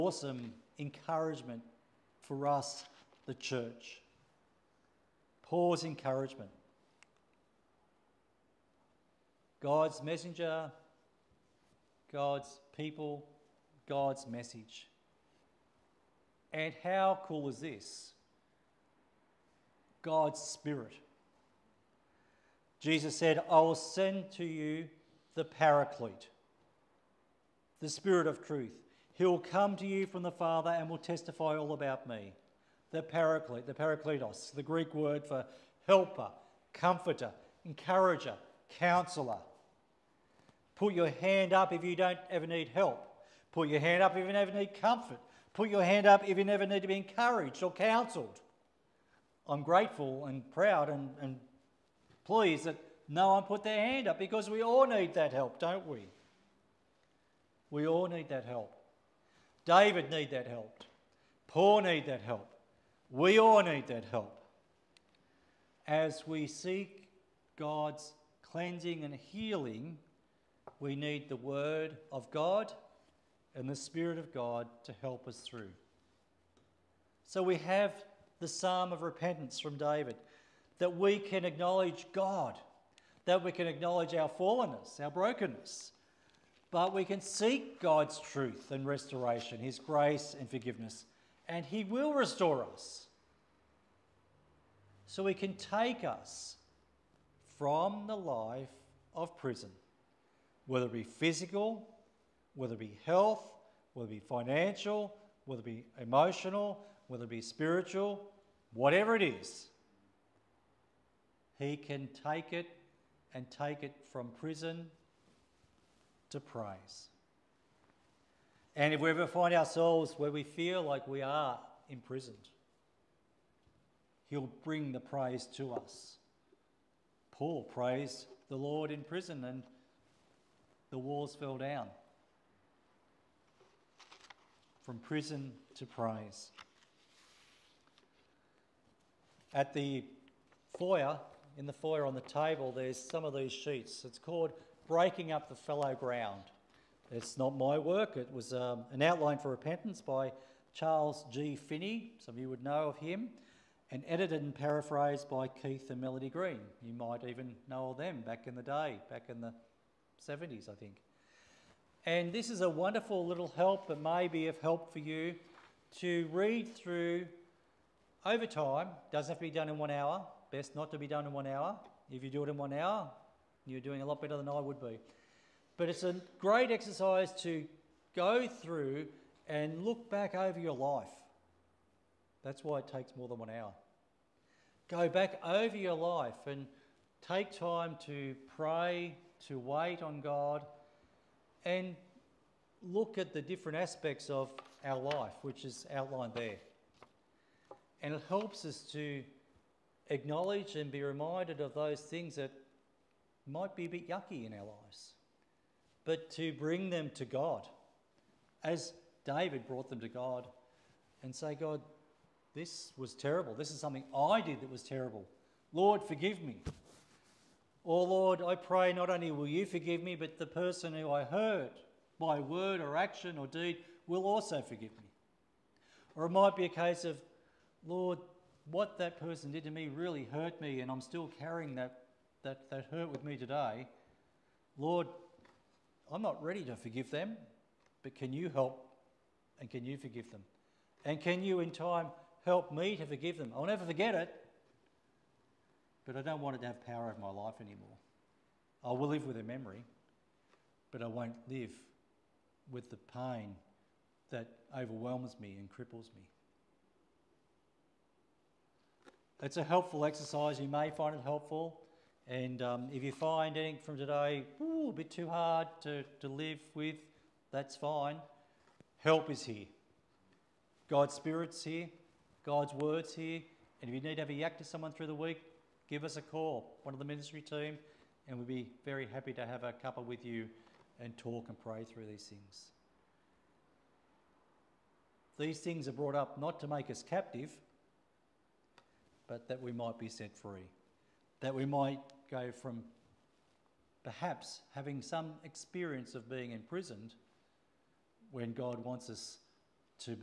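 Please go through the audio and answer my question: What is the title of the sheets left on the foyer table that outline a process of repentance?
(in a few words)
Breaking Up the Fallow Ground.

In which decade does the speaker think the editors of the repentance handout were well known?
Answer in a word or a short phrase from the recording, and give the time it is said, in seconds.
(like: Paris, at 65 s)
the 70s, at 159 s.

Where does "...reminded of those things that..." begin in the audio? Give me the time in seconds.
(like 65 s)
201 s.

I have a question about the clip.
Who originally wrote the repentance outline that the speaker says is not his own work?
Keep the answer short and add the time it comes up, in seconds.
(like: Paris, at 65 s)
Charles G. Finney, at 150 s.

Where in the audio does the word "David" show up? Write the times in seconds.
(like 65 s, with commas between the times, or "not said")
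59 s, 79 s, 209 s.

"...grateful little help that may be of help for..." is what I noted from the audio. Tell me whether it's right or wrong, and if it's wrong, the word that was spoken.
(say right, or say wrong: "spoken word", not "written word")
wrong: "wonderful", not "grateful".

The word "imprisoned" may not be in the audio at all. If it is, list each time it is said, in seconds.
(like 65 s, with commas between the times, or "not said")
121 s, 296 s.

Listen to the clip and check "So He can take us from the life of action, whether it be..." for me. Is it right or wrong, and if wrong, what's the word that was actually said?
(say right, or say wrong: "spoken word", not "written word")
wrong: "prison", not "action".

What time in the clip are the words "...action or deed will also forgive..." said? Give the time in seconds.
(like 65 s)
222 s.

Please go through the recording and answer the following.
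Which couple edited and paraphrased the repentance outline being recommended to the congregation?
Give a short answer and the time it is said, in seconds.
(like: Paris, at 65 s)
Keith and Melody Green, at 155 s.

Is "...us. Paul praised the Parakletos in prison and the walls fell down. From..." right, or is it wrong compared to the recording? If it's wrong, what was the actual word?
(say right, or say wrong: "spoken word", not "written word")
wrong: "Lord", not "Parakletos".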